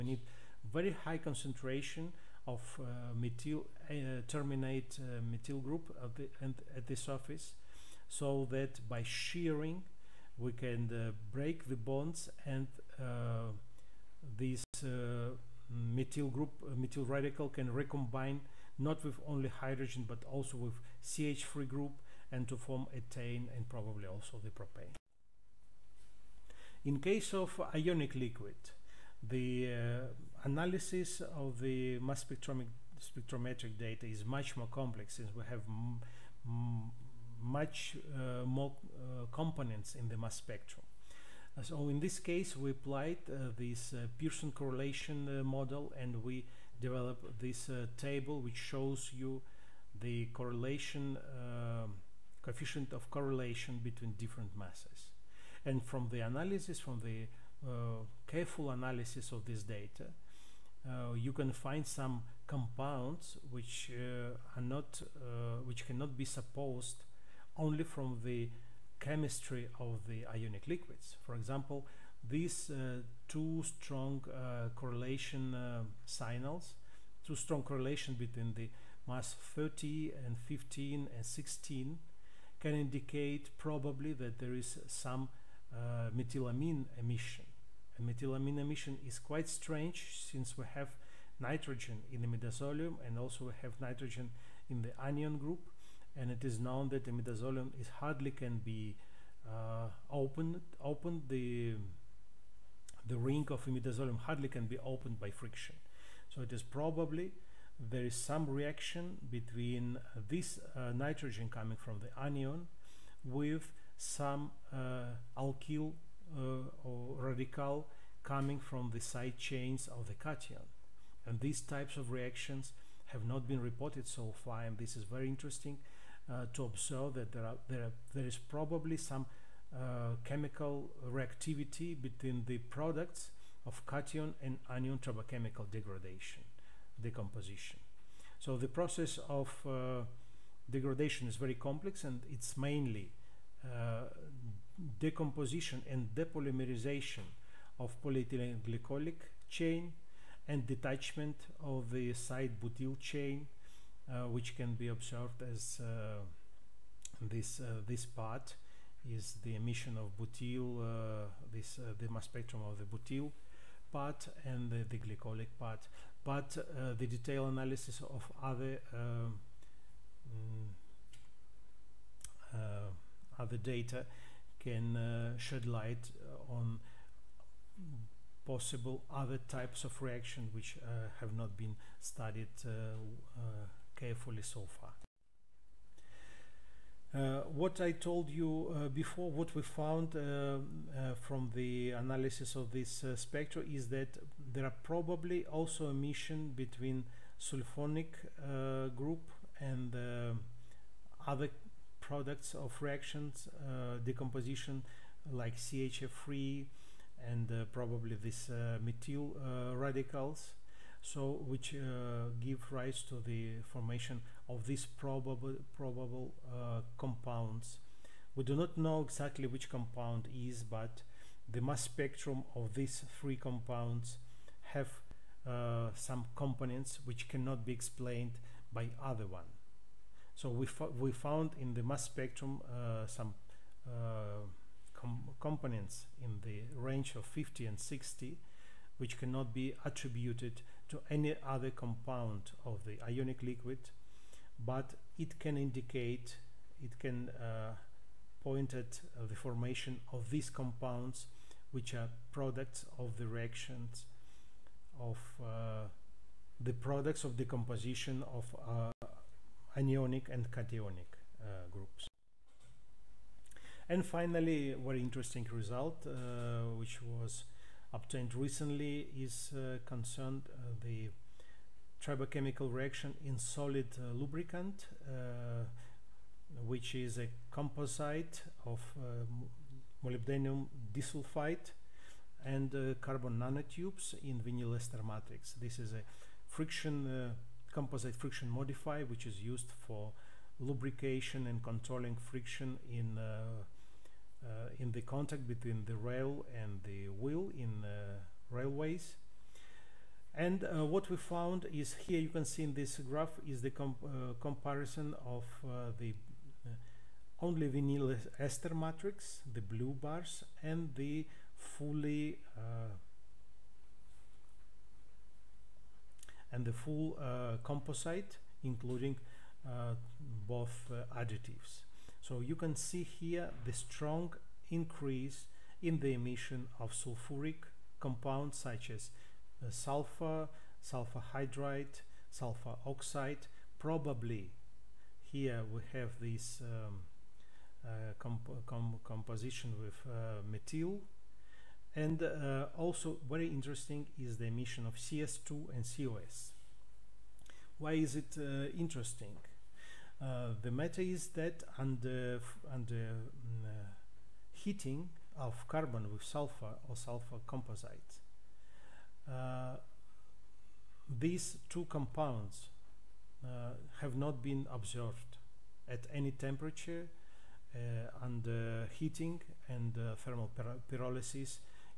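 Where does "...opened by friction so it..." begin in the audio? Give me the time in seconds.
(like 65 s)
104 s.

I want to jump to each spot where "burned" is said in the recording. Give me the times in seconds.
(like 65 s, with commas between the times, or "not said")
not said.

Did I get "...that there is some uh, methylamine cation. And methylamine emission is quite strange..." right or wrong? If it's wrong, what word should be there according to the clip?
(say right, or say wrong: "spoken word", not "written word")
wrong: "emission", not "cation".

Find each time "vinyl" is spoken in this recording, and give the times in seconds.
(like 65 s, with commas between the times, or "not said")
284 s, 307 s.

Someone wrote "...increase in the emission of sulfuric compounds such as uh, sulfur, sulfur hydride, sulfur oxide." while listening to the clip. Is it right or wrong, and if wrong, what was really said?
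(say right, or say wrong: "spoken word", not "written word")
right.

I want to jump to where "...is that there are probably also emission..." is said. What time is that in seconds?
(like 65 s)
193 s.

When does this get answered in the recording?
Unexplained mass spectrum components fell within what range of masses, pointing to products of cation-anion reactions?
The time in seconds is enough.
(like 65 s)
237 s.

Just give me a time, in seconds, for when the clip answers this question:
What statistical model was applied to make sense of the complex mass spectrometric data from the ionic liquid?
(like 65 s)
44 s.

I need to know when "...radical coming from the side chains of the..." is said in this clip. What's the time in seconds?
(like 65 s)
117 s.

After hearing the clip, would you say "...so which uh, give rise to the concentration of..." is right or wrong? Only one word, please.
wrong.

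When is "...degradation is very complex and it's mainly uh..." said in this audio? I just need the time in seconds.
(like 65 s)
140 s.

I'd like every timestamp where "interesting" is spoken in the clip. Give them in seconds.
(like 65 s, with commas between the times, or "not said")
125 s, 265 s, 343 s, 348 s.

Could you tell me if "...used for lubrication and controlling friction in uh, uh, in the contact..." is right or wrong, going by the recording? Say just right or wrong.
right.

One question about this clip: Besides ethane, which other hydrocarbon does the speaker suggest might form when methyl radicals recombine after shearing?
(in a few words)
propane.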